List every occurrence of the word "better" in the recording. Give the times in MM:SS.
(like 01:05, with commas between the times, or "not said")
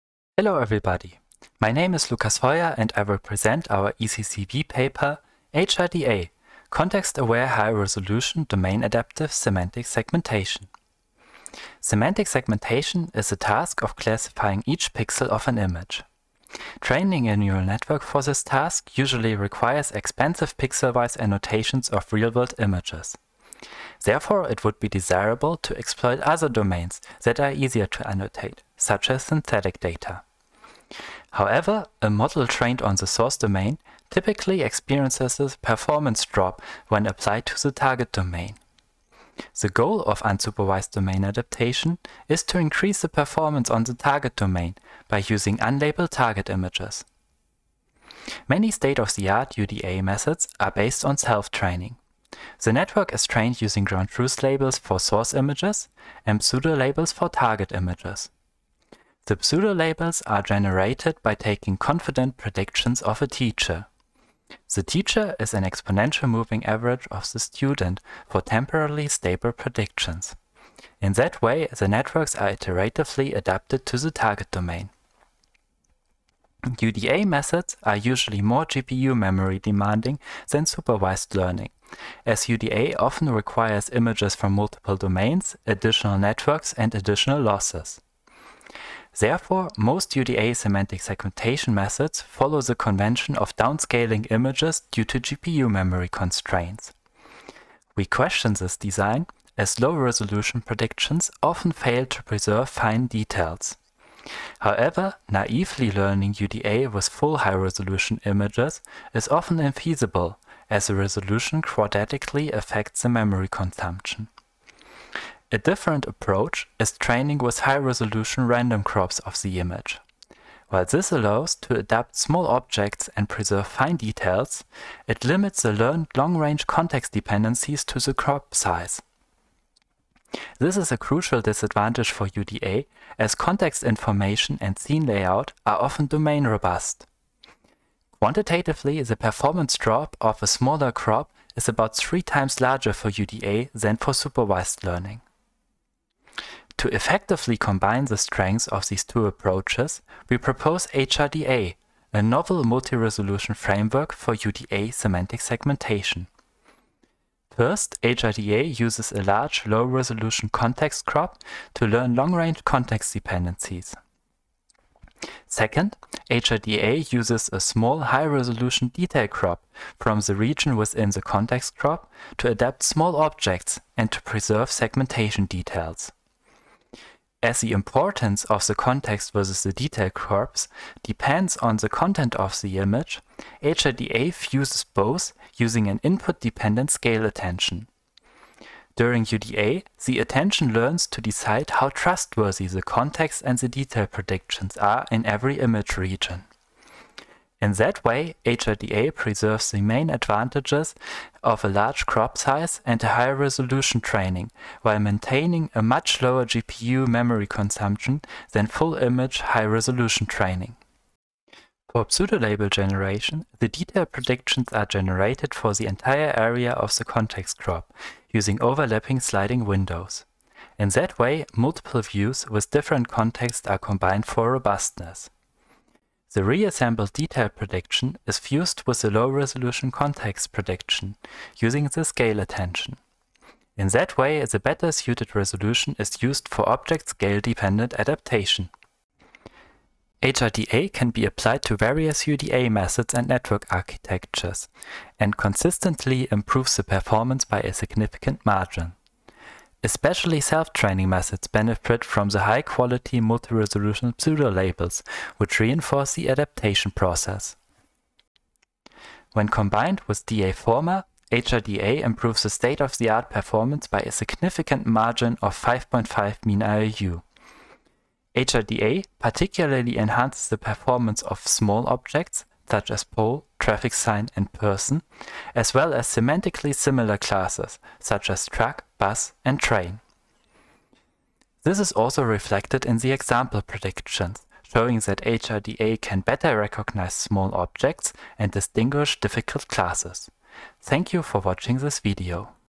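03:54, 04:46.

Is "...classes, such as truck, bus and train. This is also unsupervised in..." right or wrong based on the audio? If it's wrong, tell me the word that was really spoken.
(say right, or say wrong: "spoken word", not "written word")
wrong: "reflected", not "unsupervised".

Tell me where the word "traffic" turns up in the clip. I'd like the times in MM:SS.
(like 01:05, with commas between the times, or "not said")
04:33.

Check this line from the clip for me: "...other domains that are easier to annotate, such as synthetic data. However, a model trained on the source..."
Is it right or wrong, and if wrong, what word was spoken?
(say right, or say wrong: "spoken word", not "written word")
right.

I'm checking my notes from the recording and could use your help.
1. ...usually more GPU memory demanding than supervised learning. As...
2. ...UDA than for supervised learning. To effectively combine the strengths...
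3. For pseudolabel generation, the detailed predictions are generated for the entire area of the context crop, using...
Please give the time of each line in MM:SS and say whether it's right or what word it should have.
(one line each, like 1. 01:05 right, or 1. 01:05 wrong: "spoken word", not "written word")
1. 01:17 right
2. 02:23 right
3. 03:31 right.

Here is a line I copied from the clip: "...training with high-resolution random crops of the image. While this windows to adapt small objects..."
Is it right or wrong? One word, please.
wrong.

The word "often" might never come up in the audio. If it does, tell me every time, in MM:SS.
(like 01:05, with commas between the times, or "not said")
01:22, 01:41, 01:49, 02:15.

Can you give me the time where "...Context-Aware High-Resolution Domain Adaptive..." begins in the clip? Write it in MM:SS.
00:06.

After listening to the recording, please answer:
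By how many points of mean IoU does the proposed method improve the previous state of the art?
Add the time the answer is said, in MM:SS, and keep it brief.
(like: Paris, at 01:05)
5.5, at 04:25.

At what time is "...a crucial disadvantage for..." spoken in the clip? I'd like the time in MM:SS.
02:10.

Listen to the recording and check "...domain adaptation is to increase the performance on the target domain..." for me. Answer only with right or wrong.
right.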